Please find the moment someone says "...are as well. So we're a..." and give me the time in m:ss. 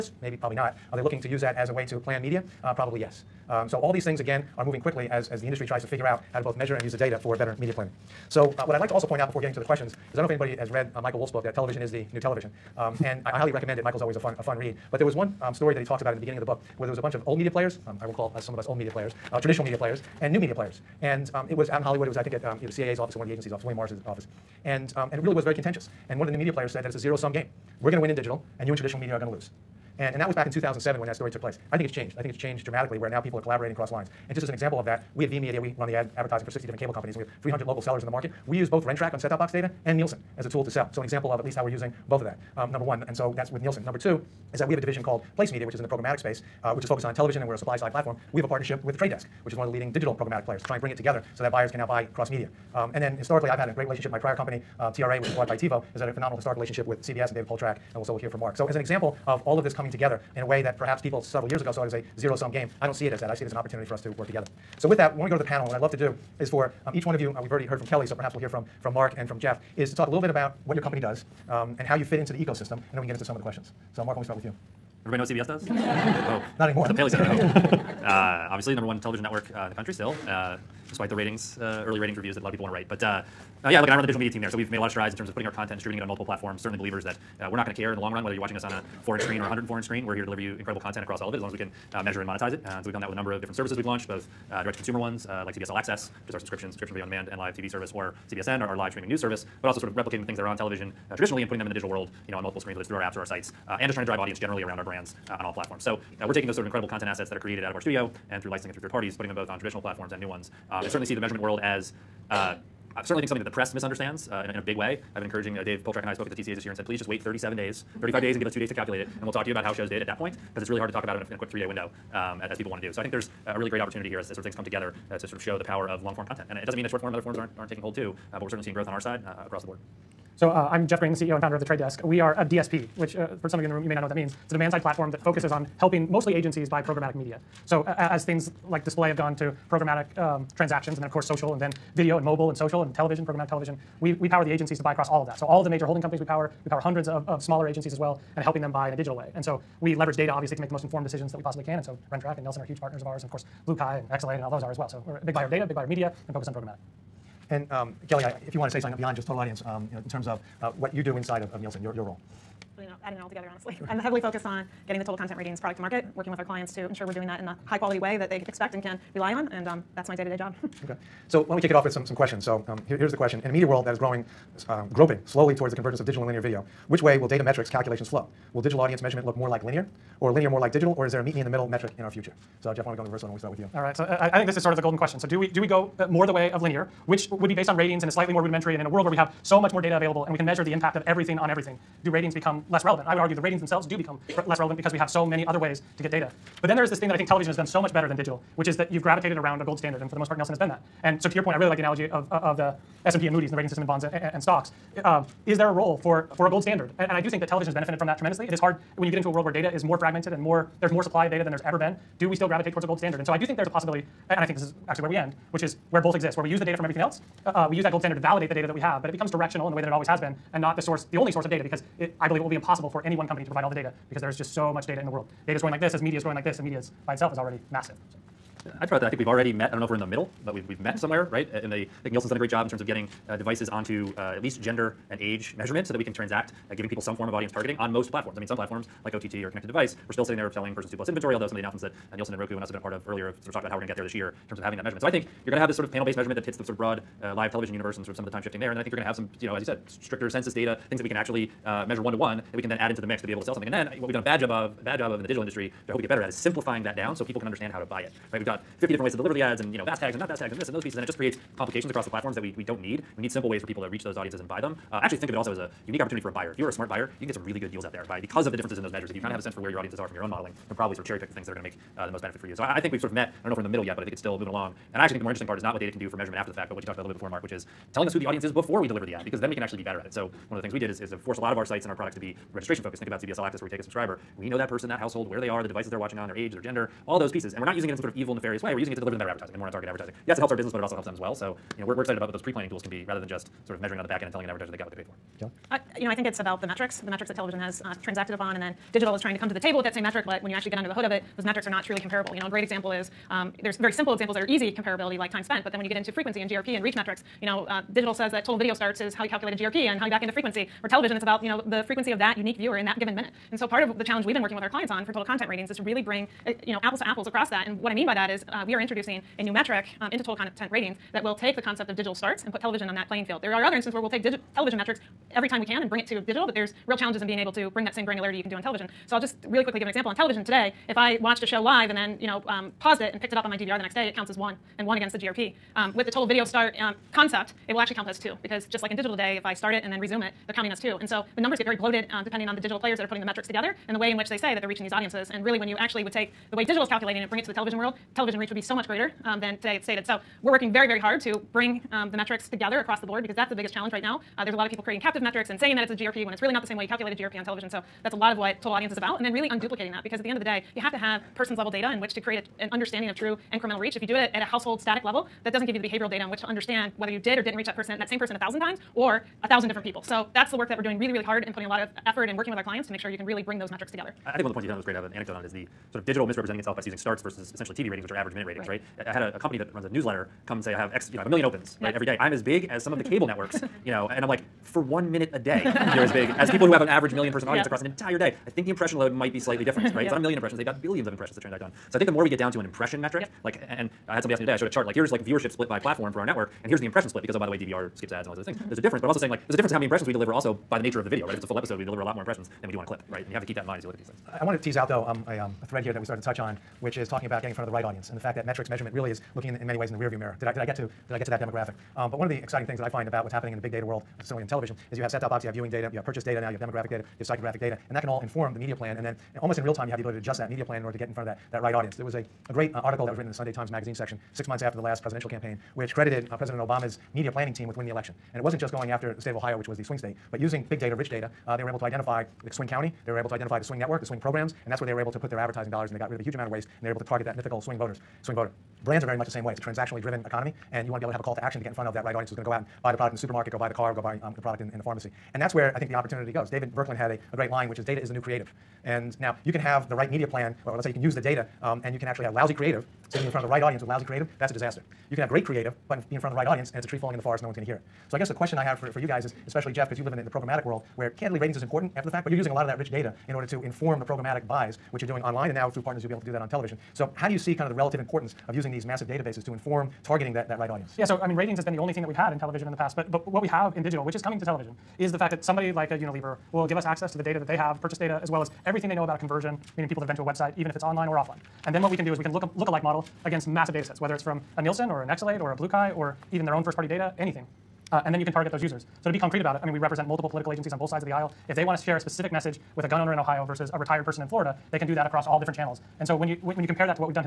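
2:34.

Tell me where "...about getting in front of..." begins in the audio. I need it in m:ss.
6:47.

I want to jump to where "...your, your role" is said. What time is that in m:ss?
2:41.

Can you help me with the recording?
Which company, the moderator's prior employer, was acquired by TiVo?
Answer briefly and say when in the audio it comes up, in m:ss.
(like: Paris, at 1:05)
TRA, at 0:54.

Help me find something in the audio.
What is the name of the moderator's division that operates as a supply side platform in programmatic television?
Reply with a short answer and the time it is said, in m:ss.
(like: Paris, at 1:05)
Place Media, at 0:45.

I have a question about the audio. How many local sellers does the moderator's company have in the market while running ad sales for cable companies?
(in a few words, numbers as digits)
300.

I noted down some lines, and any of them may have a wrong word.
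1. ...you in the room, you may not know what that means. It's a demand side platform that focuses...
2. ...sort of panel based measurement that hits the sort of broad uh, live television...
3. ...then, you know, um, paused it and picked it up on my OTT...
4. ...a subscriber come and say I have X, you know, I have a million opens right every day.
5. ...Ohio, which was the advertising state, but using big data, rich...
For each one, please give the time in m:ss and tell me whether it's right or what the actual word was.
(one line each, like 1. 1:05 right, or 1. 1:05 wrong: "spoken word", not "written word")
1. 2:13 right
2. 4:05 right
3. 5:31 wrong: "DVR", not "OTT"
4. 6:19 wrong: "newsletter", not "subscriber"
5. 7:09 wrong: "swing", not "advertising".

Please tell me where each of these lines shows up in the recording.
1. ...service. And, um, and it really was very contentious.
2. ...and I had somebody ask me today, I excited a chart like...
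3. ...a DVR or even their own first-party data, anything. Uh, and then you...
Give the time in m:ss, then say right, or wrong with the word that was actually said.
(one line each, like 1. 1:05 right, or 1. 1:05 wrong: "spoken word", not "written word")
1. 0:24 wrong: "office", not "service"
2. 6:33 wrong: "showed", not "excited"
3. 8:05 wrong: "BlueKai", not "DVR".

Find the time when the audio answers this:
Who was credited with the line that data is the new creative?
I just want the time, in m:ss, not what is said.
7:26.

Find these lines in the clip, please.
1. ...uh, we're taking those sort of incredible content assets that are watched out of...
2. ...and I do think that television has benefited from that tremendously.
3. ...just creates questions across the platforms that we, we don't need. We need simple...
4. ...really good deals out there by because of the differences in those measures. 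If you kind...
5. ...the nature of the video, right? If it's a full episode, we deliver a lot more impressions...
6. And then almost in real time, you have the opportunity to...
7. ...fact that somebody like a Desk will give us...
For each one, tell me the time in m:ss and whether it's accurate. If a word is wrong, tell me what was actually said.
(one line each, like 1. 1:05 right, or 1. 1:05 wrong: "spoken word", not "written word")
1. 1:46 wrong: "created", not "watched"
2. 3:27 right
3. 4:21 wrong: "complications", not "questions"
4. 4:27 right
5. 6:40 right
6. 6:58 wrong: "ability", not "opportunity"
7. 7:55 wrong: "Unilever", not "Desk".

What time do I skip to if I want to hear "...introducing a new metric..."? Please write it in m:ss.
5:18.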